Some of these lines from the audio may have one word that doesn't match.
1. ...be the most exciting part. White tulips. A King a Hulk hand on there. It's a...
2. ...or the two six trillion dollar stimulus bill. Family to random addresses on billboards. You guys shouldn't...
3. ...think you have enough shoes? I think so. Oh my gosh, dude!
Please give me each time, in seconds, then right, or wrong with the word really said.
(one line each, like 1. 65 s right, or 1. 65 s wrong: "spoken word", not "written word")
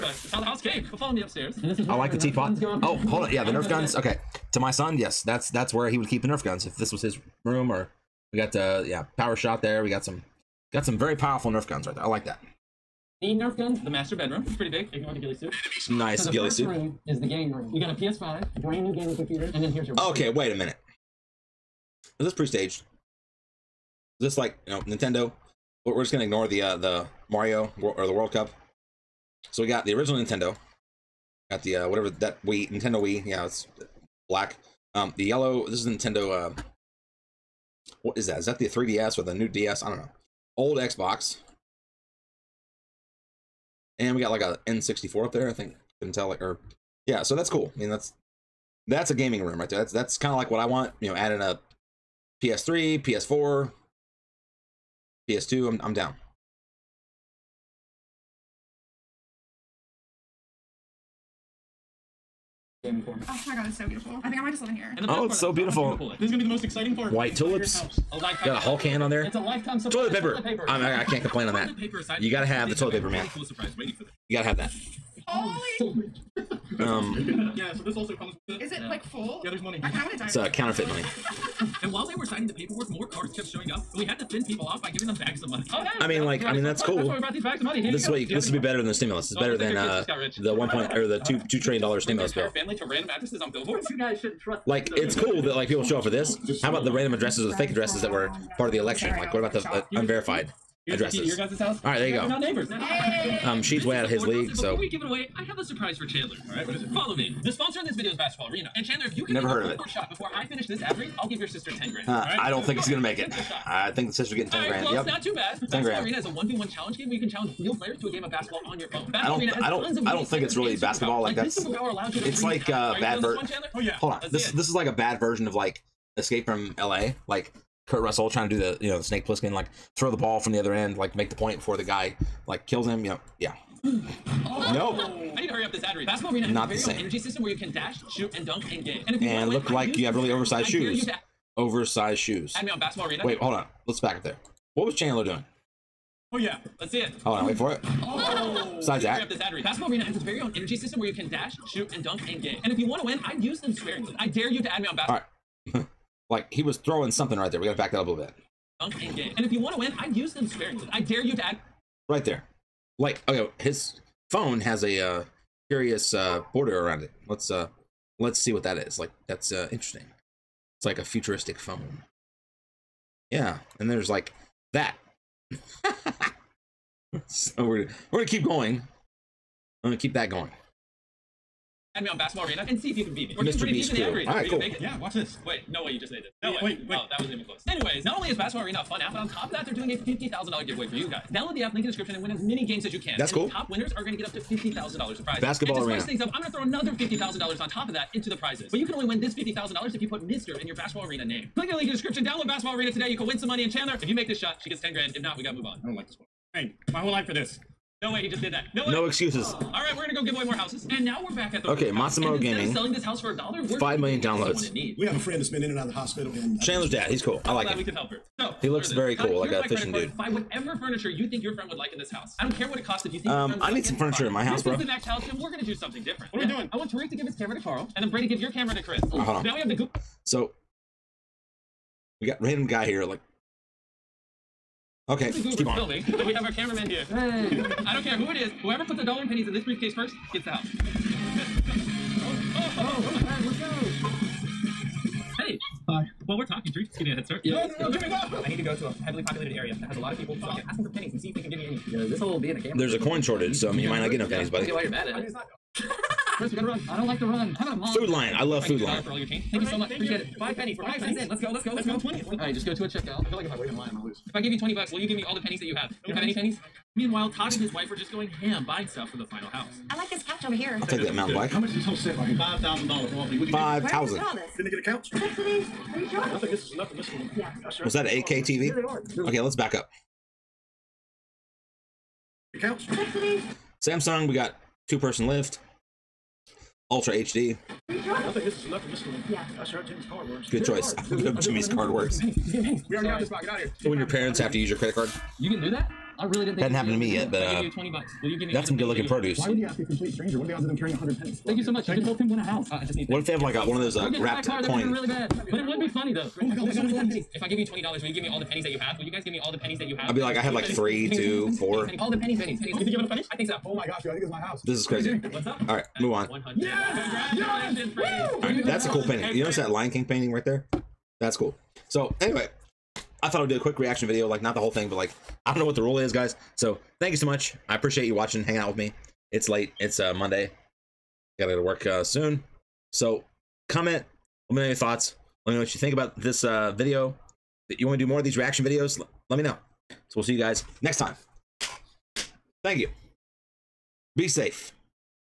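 1. 66 s wrong: "Got", not "King"
2. 90 s wrong: "two", not "six"
3. 312 s wrong: "pennies", not "shoes".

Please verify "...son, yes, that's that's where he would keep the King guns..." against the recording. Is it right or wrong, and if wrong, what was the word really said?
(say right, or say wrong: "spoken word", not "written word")
wrong: "Nerf", not "King".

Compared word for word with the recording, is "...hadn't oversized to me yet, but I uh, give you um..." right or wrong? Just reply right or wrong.
wrong.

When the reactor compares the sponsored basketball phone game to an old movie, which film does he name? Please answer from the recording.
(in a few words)
Escape from L.A.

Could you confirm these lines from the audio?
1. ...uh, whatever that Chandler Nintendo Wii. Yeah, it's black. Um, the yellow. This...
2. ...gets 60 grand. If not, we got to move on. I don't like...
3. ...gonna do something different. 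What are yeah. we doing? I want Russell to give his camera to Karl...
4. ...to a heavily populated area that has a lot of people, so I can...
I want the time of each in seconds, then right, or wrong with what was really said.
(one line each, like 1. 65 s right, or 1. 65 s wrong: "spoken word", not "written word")
1. 31 s wrong: "Wii", not "Chandler"
2. 204 s wrong: "10", not "60"
3. 225 s wrong: "Tareq", not "Russell"
4. 248 s right.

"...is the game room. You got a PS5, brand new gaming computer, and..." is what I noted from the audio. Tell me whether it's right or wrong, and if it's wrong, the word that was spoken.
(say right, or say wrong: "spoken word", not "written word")
right.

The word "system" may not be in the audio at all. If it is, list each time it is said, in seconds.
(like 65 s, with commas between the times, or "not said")
137 s, 150 s.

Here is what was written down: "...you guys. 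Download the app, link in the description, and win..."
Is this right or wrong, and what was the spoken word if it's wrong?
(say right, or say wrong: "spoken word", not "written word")
right.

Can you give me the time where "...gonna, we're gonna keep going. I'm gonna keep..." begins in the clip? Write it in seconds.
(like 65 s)
177 s.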